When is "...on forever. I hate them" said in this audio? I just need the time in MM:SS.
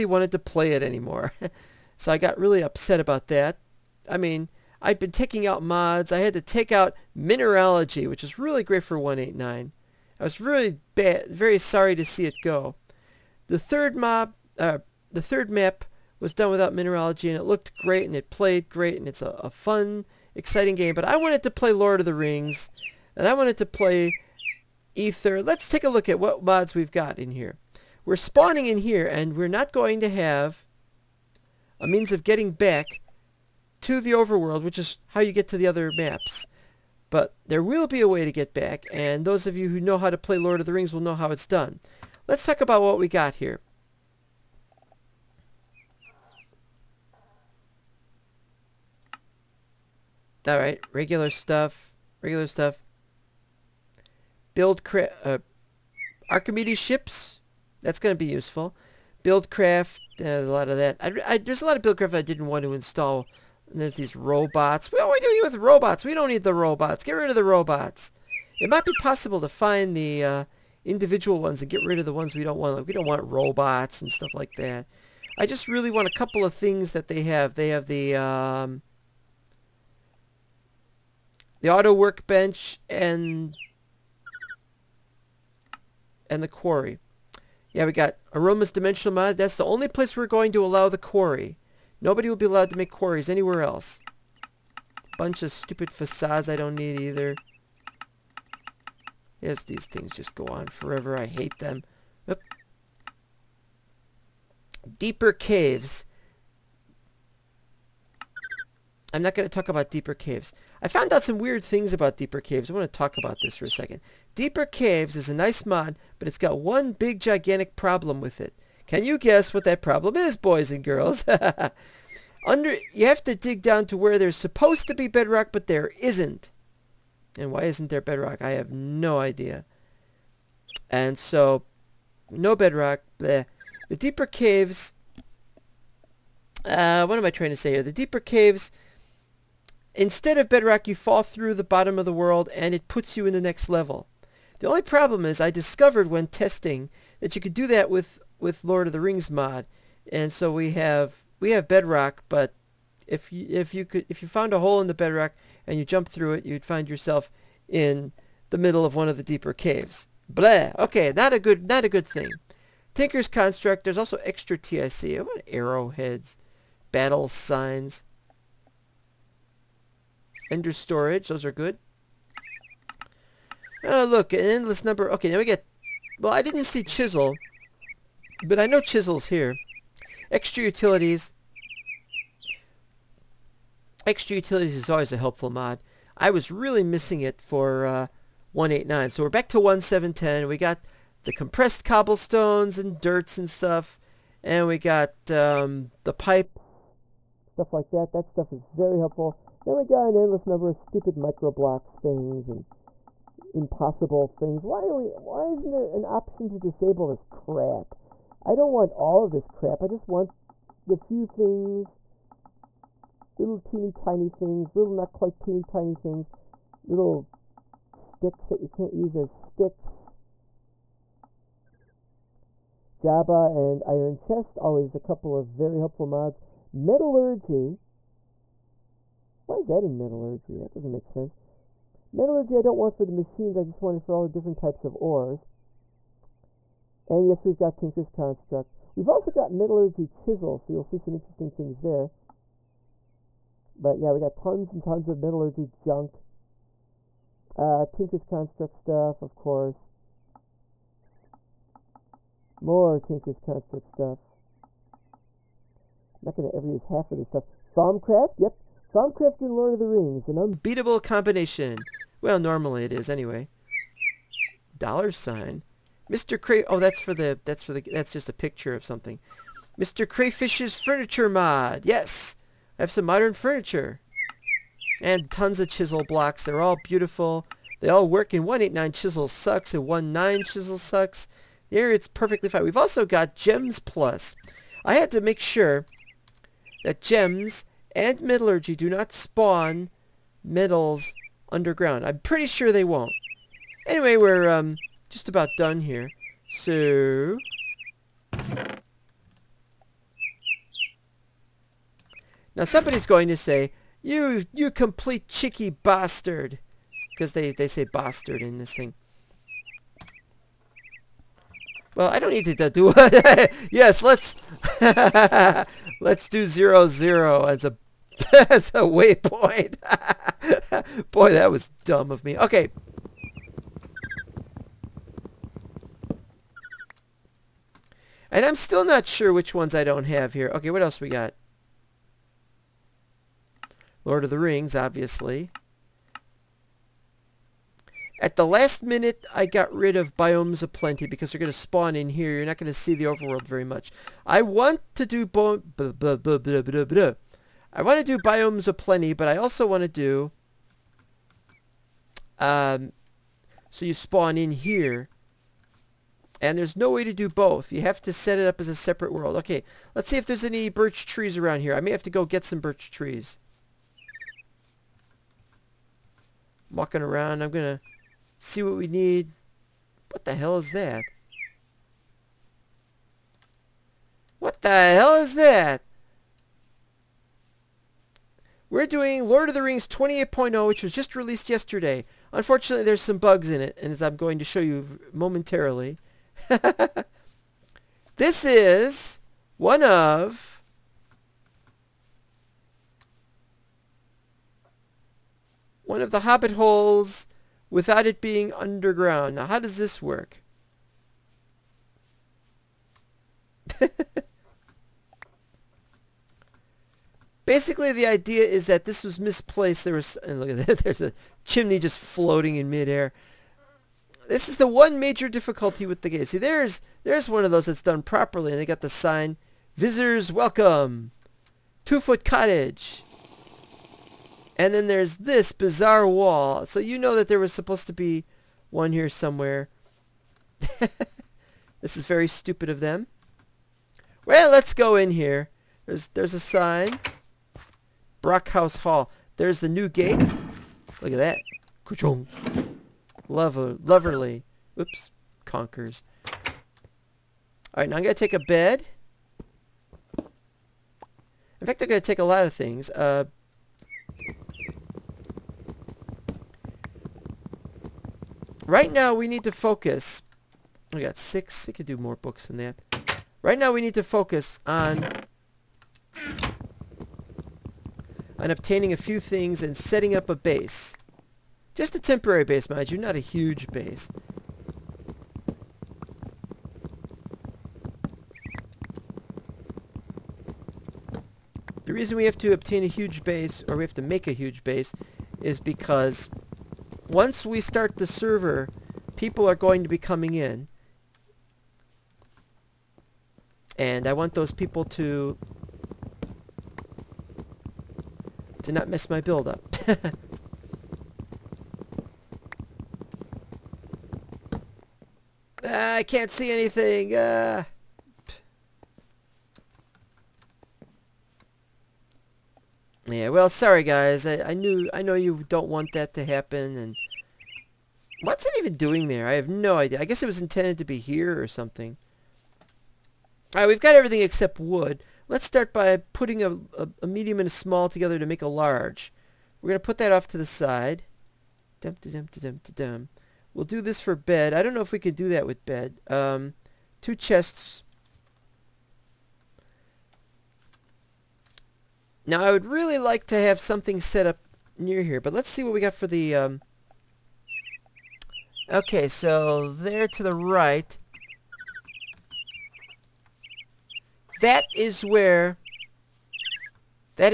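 01:40.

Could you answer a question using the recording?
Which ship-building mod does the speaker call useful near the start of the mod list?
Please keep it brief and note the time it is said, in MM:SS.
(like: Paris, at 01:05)
Archimedes ships, at 00:56.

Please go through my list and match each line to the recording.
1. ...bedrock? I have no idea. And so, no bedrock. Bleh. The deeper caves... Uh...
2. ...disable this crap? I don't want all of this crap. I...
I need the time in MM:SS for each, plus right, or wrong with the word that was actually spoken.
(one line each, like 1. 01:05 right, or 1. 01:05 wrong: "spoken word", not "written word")
1. 02:08 right
2. 03:26 right.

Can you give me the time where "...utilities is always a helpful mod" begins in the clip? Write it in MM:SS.
03:04.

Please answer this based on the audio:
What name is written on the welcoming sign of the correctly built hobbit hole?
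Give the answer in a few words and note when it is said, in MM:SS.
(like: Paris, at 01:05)
Two Foot Cottage, at 07:01.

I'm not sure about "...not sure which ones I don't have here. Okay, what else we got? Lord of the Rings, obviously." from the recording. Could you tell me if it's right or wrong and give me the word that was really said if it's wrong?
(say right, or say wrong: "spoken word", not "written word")
right.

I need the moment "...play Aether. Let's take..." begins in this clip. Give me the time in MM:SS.
00:23.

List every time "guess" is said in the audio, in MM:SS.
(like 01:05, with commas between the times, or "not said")
01:59, 08:40.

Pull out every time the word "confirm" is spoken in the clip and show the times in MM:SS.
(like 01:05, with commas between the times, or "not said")
not said.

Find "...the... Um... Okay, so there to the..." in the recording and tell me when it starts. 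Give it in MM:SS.
09:06.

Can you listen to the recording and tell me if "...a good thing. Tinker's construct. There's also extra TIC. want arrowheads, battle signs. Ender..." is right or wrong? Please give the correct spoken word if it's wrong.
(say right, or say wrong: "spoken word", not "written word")
right.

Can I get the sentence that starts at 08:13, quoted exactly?
And I want those people to to not miss my build up.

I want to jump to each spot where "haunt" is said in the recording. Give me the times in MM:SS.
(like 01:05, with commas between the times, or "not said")
not said.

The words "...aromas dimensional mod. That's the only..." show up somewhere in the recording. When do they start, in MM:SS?
01:28.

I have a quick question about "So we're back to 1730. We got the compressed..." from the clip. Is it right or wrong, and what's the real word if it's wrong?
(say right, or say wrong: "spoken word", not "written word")
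wrong: "1710", not "1730".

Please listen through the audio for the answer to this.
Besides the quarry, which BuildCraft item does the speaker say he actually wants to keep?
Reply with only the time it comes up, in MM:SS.
01:21.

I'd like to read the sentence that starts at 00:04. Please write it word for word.
I mean, I'd been taking out mods.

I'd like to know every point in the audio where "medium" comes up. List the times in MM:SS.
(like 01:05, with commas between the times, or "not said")
08:47.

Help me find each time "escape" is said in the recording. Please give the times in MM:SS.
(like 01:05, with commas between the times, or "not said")
not said.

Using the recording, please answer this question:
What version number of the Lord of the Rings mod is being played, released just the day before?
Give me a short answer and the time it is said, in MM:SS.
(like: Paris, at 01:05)
28.0, at 06:19.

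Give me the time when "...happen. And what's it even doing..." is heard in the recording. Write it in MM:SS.
08:36.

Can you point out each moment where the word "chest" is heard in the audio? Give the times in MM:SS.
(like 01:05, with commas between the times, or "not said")
03:44, 08:57.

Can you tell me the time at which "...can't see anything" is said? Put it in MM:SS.
08:26.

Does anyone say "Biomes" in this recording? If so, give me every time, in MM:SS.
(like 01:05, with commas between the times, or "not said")
05:40, 05:48.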